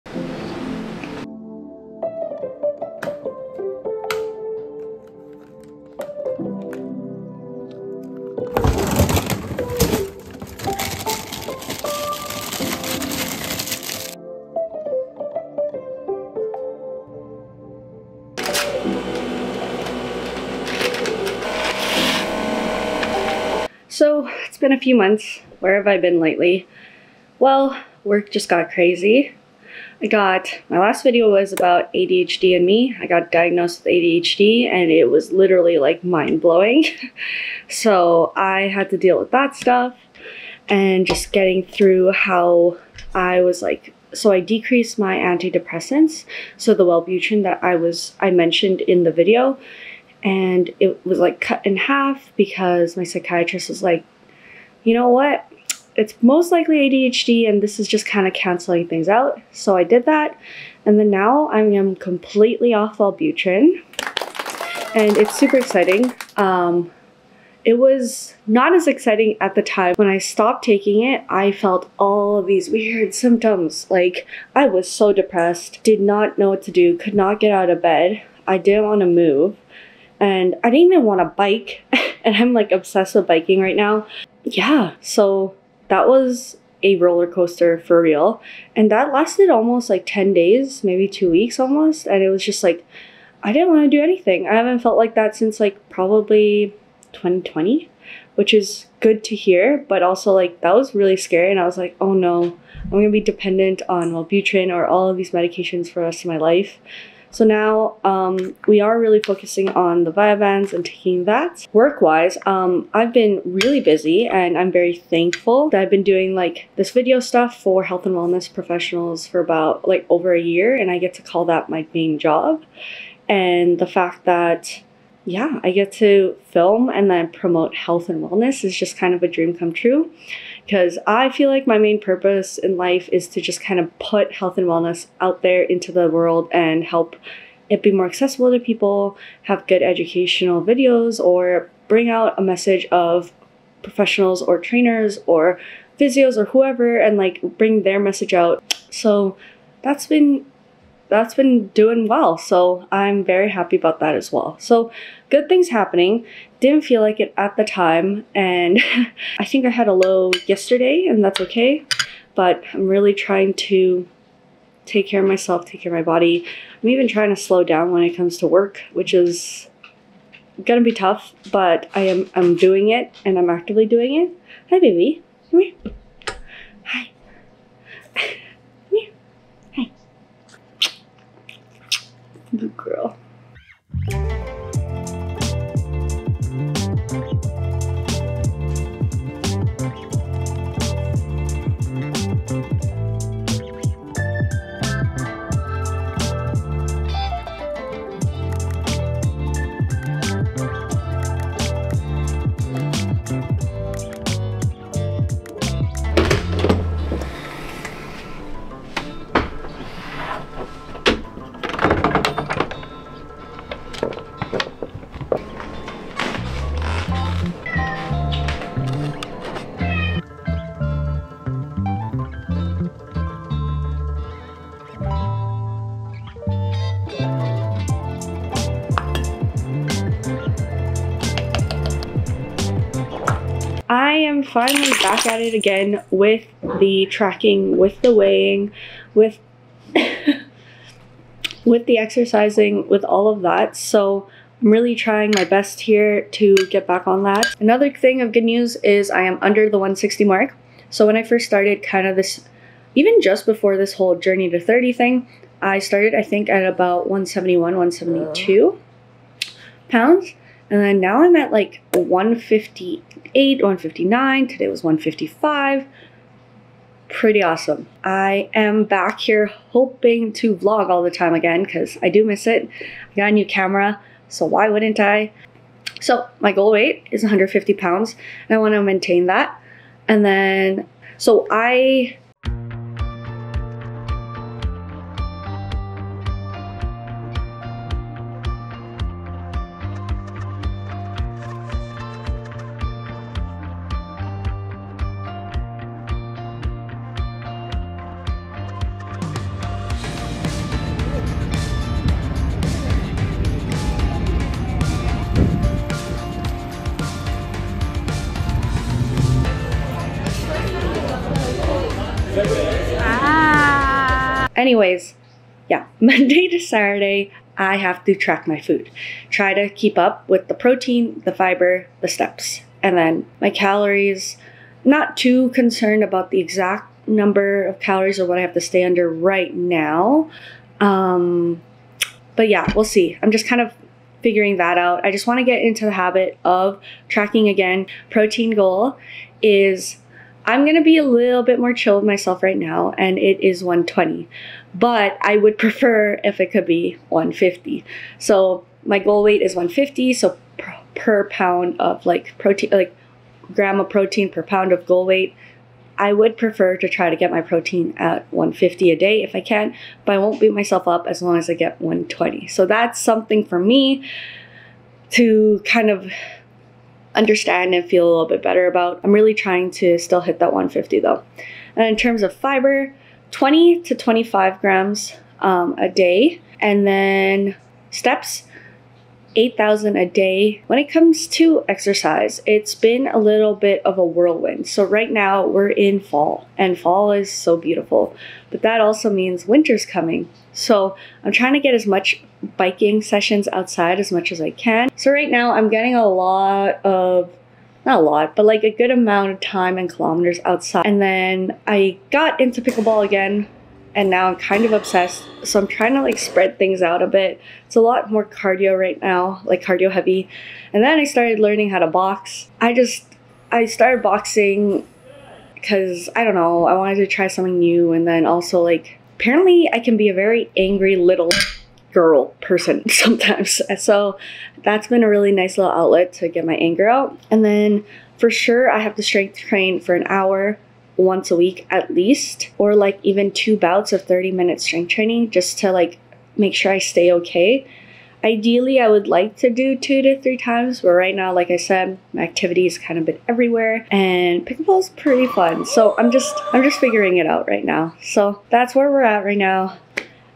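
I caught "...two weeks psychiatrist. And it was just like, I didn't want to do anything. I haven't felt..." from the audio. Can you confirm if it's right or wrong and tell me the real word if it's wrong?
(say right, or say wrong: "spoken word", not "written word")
wrong: "almost", not "psychiatrist".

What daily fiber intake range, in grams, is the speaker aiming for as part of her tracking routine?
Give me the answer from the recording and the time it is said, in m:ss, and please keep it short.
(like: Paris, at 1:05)
20 to 25 grams, at 6:13.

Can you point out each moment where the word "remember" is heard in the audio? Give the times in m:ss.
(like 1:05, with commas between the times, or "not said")
not said.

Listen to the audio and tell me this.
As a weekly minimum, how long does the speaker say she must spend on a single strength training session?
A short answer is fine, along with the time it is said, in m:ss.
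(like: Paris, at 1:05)
an hour, at 7:09.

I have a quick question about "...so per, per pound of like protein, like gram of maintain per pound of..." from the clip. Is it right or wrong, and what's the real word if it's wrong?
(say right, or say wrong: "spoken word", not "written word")
wrong: "protein", not "maintain".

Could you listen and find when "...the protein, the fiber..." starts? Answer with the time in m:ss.
5:20.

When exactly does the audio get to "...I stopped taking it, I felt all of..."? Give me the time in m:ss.
1:10.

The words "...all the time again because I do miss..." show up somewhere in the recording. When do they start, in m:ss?
4:30.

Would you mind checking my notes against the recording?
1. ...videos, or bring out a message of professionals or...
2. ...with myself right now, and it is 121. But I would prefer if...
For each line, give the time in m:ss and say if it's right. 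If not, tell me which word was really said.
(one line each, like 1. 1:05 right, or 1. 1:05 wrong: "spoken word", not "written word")
1. 2:20 right
2. 5:41 wrong: "120", not "121".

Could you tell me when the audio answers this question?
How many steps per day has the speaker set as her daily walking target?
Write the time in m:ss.
6:19.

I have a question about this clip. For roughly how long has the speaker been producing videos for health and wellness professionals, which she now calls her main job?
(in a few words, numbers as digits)
over a year.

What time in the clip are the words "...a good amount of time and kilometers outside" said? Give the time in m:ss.
6:38.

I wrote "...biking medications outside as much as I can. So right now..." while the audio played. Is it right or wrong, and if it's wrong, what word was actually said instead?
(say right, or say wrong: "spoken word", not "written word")
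wrong: "sessions", not "medications".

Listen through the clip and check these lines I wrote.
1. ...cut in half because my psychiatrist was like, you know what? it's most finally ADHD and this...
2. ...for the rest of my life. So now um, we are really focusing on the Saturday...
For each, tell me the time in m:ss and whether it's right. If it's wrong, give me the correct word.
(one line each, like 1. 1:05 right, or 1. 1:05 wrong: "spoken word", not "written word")
1. 0:51 wrong: "likely", not "finally"
2. 1:45 wrong: "Vyvanse", not "Saturday".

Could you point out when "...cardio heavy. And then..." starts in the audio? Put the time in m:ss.
6:49.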